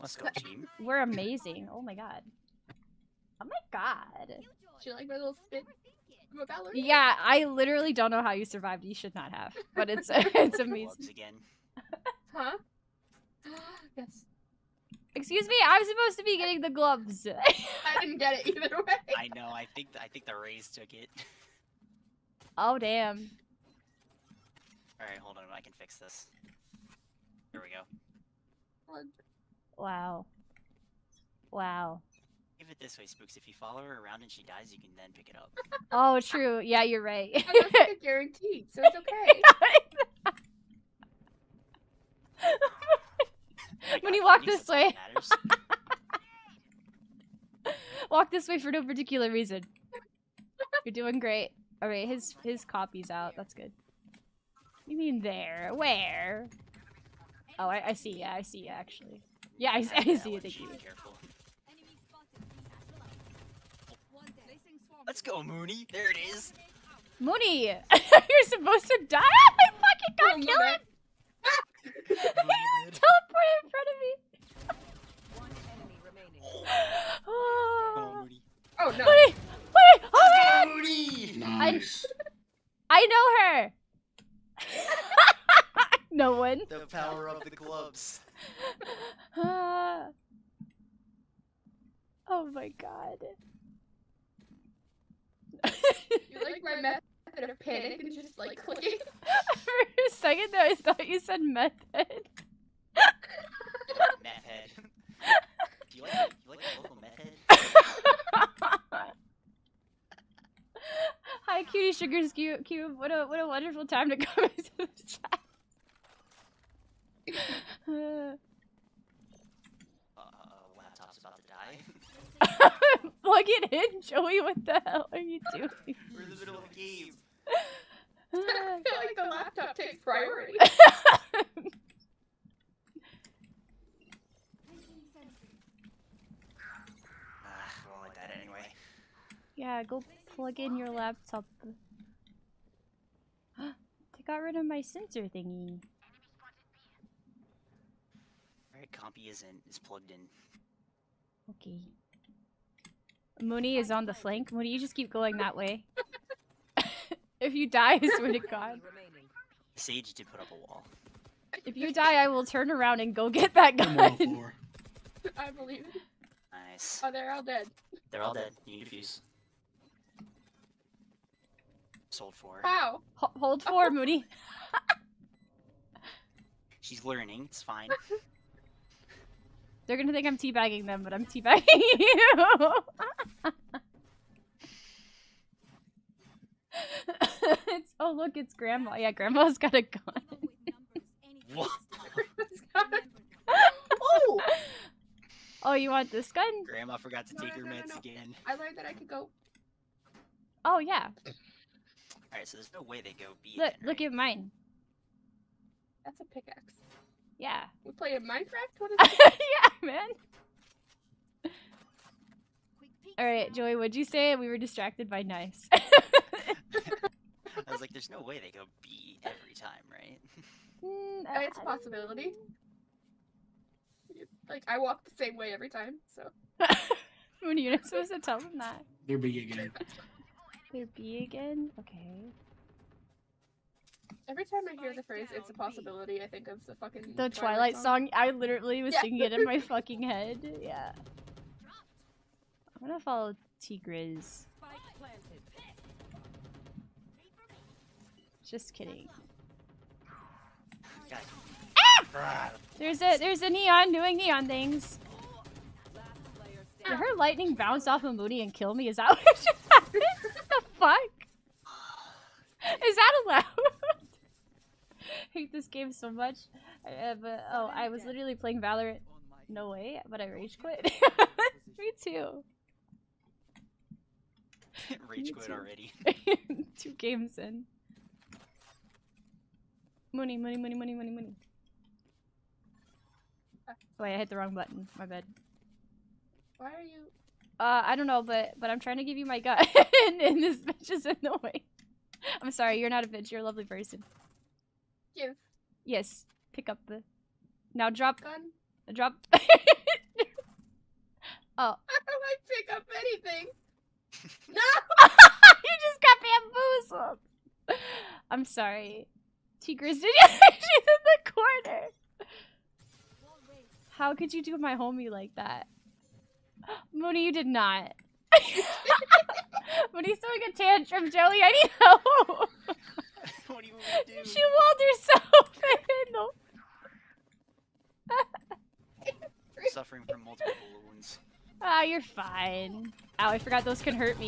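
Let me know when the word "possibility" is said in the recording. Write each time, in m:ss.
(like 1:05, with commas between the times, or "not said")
3:41, 3:55.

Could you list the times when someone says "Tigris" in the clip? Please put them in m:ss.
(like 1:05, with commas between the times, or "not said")
4:03, 5:09.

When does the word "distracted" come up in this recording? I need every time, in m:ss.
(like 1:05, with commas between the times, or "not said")
3:34.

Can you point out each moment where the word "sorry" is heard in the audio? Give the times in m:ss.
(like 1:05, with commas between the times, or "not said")
4:52, 5:08.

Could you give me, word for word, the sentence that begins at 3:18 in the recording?
I learned that I could go.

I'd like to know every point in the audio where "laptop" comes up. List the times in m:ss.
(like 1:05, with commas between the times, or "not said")
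2:00, 2:09, 2:20.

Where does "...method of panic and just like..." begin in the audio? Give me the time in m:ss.
1:36.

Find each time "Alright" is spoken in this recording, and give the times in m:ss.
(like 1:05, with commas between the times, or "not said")
2:28, 3:22.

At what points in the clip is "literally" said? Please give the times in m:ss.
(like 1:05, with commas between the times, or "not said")
0:07, 3:58, 4:28.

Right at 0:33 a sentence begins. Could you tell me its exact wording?
If you follow her around and she dies, you can then pick it up.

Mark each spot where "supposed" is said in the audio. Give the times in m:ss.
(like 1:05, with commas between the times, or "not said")
0:15, 1:08, 3:47.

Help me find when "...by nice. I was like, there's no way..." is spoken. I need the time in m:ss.
3:35.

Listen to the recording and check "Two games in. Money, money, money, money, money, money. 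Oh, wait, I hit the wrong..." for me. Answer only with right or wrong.
right.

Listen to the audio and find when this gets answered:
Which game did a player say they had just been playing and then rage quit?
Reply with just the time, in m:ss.
4:28.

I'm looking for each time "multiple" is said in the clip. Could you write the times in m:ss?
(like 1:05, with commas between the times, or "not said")
5:30.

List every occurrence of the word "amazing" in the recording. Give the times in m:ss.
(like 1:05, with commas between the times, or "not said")
0:01, 0:10.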